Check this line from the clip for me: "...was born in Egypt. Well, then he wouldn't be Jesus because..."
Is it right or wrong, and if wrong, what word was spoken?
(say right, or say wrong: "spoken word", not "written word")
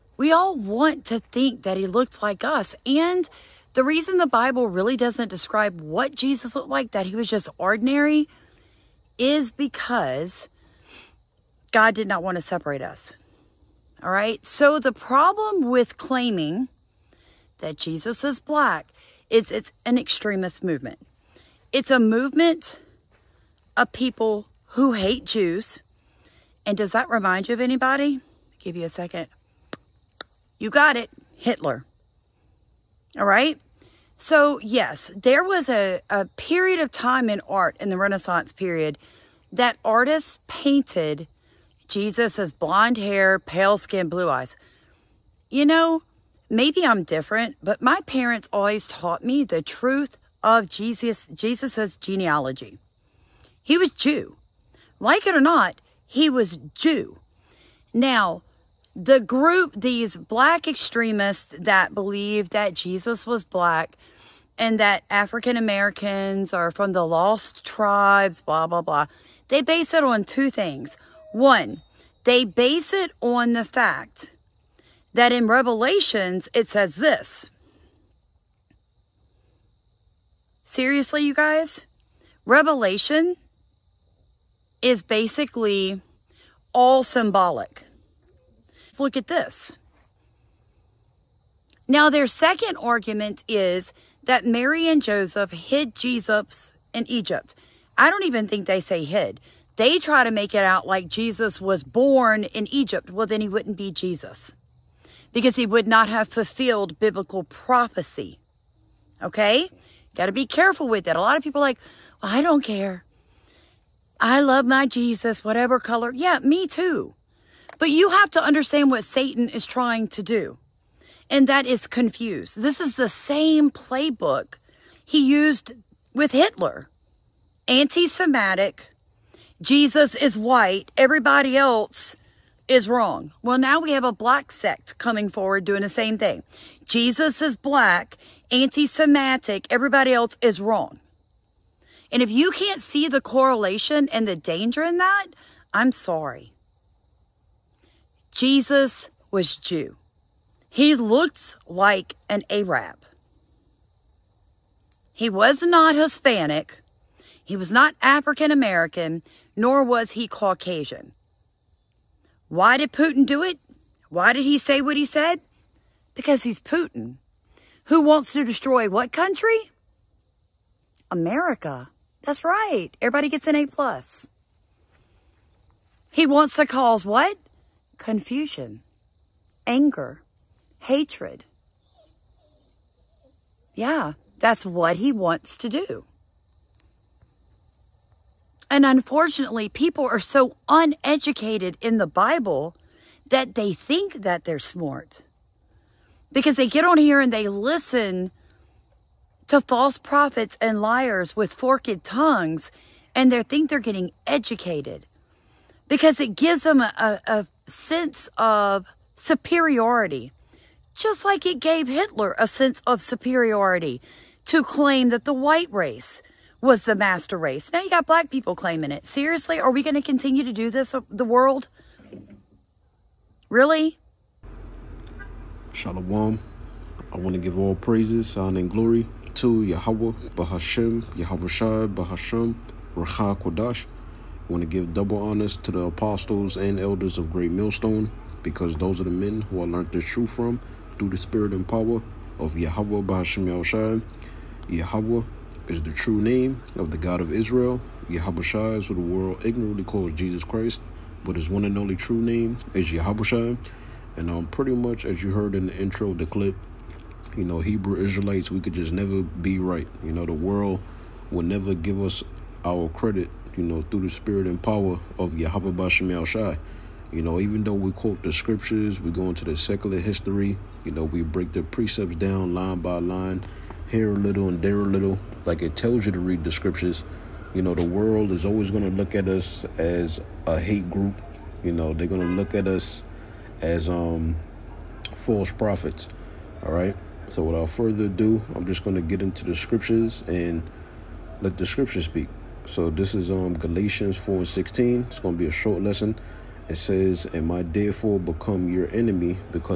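right.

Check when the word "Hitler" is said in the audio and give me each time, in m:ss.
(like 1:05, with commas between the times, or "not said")
0:31, 2:06, 3:31.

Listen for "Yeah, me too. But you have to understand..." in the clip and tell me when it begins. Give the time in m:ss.
1:56.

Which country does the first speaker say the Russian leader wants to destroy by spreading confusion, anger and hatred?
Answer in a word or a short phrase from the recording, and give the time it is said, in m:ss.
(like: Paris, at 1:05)
America, at 2:51.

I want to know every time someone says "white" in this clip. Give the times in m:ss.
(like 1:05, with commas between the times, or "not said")
2:10, 3:35.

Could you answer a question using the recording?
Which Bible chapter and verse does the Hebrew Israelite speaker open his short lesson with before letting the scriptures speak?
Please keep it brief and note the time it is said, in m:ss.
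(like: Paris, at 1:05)
Galatians 4:16, at 4:53.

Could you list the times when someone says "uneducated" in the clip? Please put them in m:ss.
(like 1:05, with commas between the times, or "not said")
3:10.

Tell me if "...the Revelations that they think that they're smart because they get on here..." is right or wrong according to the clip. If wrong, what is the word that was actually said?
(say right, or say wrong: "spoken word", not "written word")
wrong: "Bible", not "Revelations".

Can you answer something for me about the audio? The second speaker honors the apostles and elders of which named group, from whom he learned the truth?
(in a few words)
Great Millstone.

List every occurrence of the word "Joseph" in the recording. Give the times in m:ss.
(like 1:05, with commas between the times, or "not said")
1:35.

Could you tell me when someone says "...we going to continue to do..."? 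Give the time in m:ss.
3:39.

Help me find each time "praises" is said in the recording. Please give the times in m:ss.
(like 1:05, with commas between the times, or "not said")
3:47.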